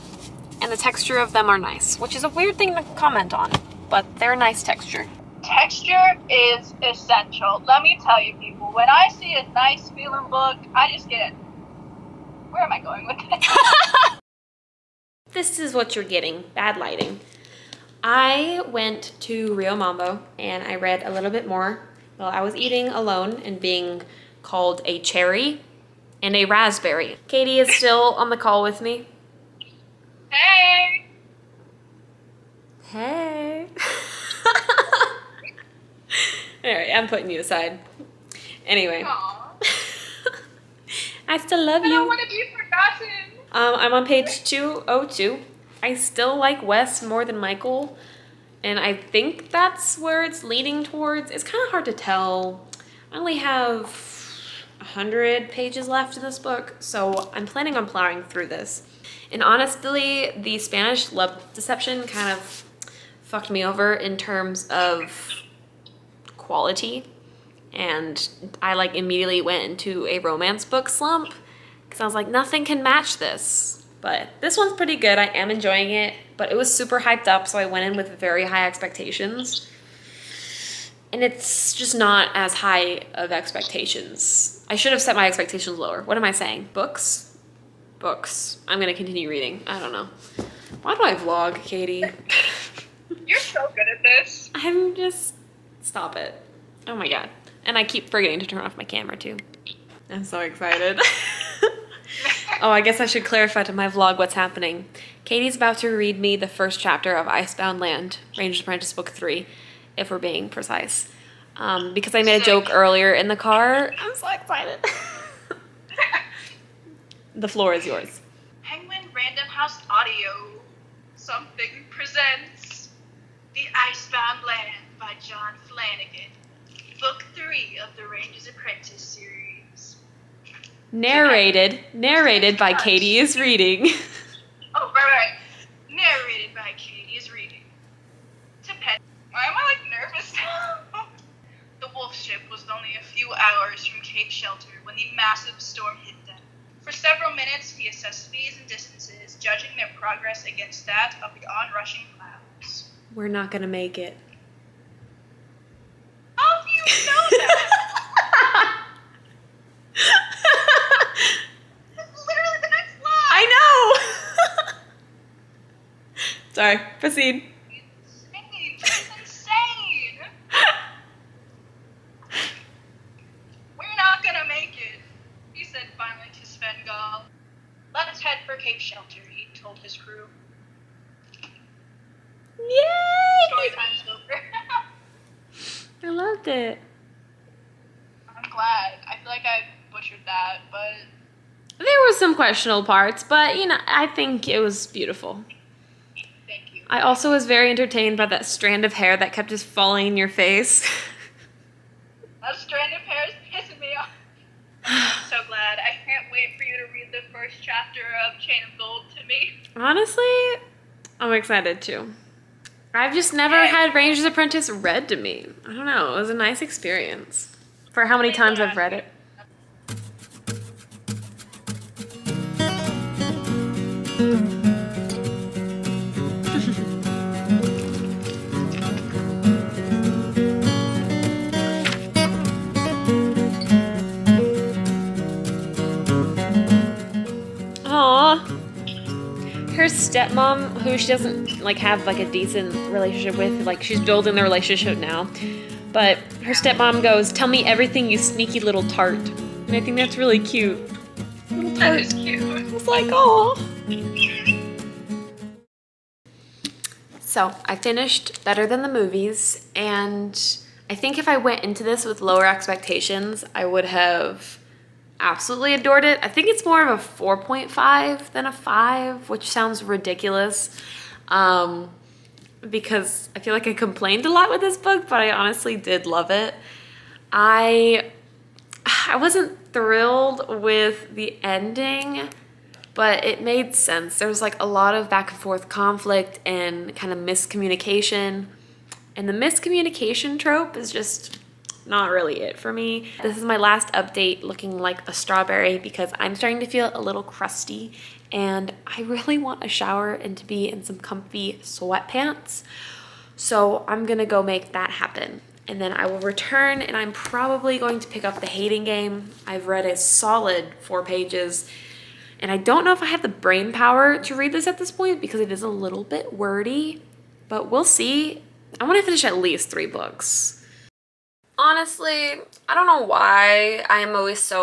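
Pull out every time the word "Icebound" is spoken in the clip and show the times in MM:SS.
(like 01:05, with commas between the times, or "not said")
01:47, 02:03.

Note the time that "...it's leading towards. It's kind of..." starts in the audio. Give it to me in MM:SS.
00:50.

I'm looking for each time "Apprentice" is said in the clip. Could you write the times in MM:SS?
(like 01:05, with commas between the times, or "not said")
01:48, 02:08, 03:34.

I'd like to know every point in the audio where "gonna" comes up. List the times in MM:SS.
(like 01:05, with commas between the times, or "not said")
01:28, 05:04.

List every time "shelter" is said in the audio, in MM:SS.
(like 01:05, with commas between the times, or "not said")
02:24, 02:58.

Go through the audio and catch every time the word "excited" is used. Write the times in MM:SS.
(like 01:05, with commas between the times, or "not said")
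01:40, 01:54, 03:31.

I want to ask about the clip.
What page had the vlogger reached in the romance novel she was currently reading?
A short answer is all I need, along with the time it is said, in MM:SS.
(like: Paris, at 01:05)
202, at 00:44.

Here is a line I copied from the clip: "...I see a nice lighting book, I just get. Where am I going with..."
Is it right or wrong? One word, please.
wrong.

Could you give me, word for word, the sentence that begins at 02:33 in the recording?
We're not going to make it.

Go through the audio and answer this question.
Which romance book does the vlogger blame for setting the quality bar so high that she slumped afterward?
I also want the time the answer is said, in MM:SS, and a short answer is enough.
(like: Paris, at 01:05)
The Spanish Love Deception, at 01:00.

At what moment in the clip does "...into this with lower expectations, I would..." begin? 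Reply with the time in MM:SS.
04:21.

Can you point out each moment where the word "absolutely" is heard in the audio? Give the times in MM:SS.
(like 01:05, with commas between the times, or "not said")
04:25.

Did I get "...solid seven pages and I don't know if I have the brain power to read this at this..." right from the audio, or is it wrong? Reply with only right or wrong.
wrong.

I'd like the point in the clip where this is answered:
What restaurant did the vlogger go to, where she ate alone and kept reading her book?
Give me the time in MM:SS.
00:19.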